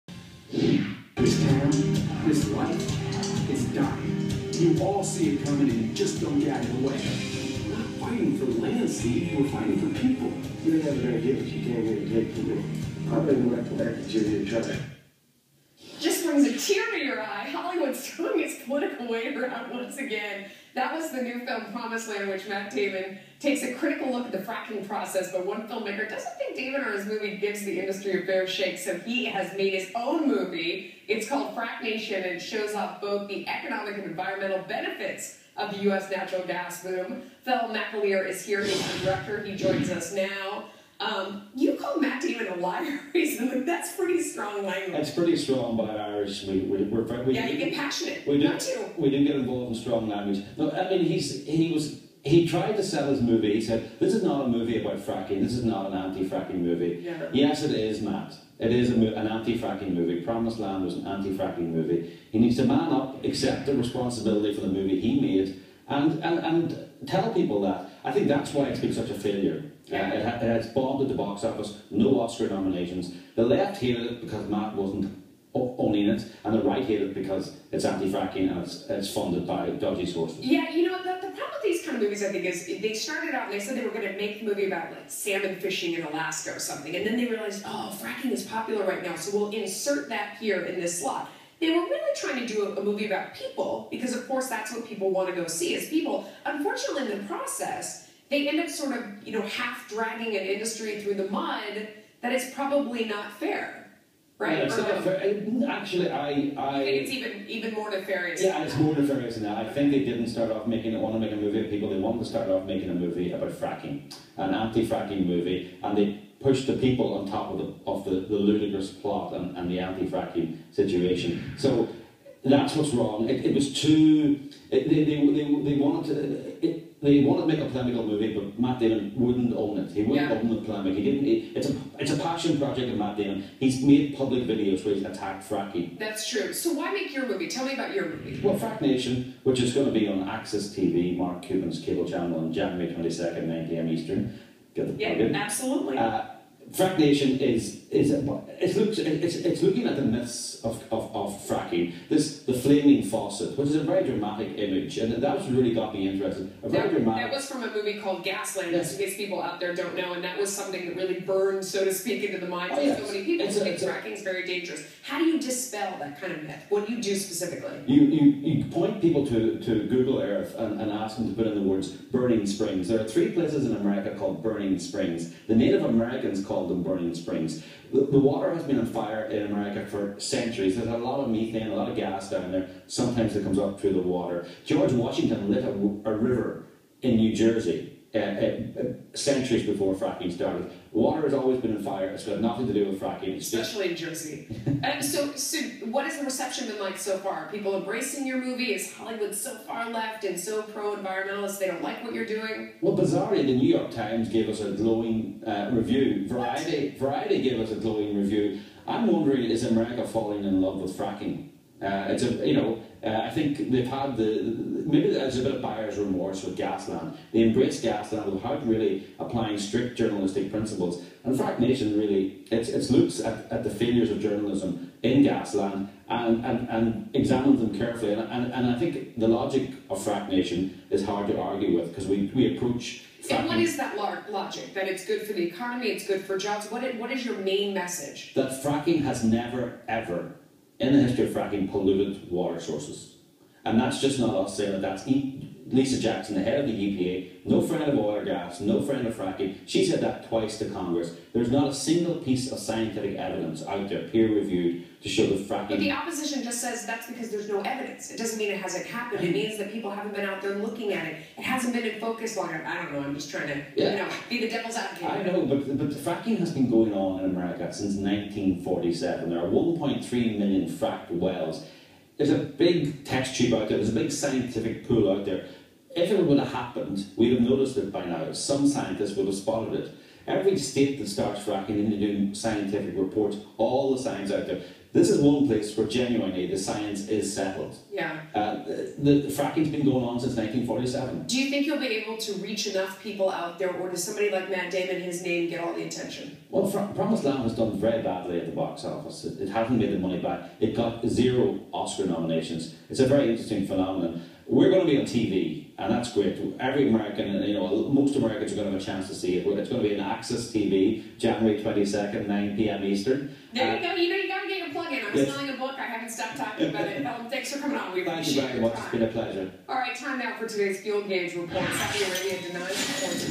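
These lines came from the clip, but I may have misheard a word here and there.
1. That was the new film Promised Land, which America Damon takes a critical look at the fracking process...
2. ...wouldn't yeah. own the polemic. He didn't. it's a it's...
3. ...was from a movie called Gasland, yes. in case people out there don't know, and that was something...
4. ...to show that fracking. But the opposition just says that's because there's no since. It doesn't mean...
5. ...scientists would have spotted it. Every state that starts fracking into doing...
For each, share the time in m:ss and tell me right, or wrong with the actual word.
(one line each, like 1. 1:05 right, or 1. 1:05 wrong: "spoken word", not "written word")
1. 0:20 wrong: "Matt", not "America"
2. 2:10 right
3. 2:37 right
4. 4:15 wrong: "evidence", not "since"
5. 4:38 right.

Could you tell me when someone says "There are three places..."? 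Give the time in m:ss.
2:52.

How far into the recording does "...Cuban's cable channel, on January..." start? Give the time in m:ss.
2:21.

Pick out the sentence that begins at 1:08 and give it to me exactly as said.
I think that's why it's been such a failure.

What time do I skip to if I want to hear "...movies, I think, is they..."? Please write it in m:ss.
1:22.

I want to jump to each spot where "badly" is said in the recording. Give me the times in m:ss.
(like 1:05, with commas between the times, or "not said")
4:58.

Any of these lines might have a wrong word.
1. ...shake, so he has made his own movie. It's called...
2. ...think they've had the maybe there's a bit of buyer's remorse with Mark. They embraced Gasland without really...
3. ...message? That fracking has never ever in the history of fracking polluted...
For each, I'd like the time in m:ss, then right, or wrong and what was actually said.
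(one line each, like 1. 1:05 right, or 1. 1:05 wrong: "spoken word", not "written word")
1. 0:28 right
2. 3:33 wrong: "Gasland", not "Mark"
3. 3:57 right.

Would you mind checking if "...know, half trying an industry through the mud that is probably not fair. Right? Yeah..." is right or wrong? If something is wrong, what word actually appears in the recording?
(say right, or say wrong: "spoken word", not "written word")
wrong: "dragging", not "trying".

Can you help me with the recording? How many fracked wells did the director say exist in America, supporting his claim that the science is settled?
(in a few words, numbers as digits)
1.3 million.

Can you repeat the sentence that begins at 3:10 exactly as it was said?
Water has always been on fire.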